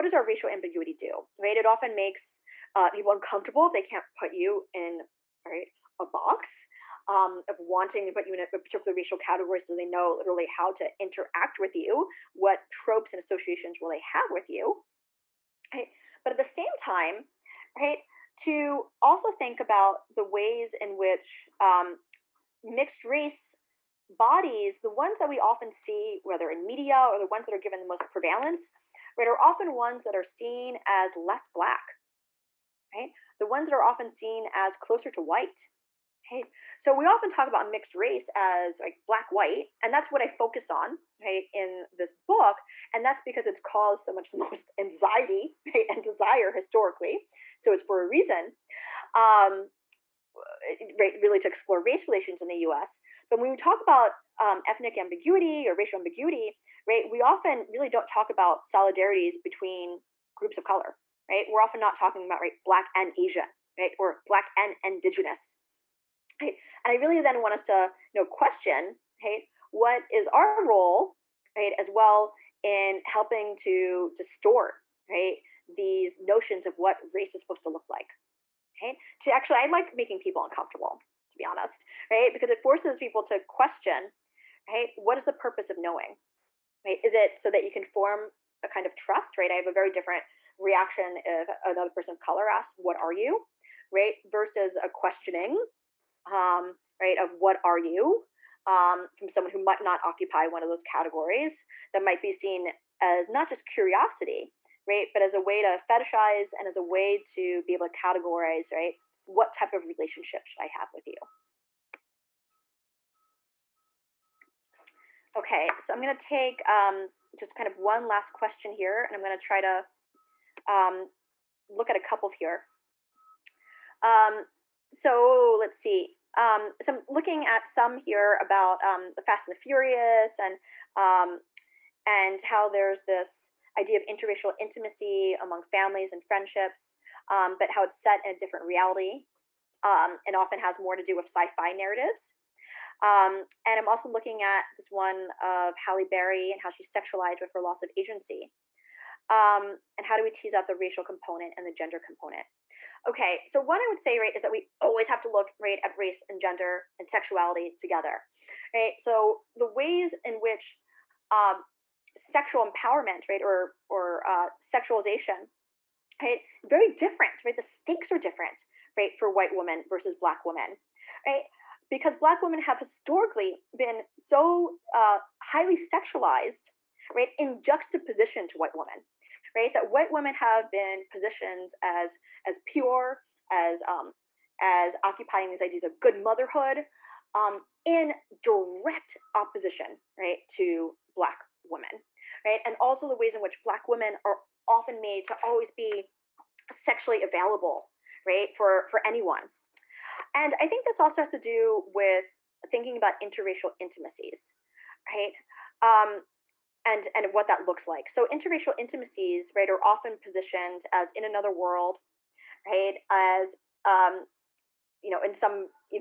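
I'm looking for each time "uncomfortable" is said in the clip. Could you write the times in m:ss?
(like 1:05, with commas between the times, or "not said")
0:03, 1:20.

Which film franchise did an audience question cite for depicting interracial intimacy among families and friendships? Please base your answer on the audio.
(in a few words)
The Fast and the Furious.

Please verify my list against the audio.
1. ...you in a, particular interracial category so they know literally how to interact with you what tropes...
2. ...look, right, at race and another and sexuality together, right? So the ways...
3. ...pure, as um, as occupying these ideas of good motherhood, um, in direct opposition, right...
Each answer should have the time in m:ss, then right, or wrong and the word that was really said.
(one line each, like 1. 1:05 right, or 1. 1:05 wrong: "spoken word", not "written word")
1. 0:08 wrong: "racial", not "interracial"
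2. 2:35 wrong: "gender", not "another"
3. 3:02 right.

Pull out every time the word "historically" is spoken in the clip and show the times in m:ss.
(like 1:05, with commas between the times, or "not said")
0:46, 2:52.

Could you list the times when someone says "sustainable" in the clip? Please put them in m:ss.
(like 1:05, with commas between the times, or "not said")
not said.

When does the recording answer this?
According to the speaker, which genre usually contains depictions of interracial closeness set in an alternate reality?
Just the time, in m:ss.
2:21.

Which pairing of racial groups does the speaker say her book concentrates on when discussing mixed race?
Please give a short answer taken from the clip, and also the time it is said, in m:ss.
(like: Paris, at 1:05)
Black white, at 0:39.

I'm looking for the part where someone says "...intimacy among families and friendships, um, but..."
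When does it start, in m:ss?
2:14.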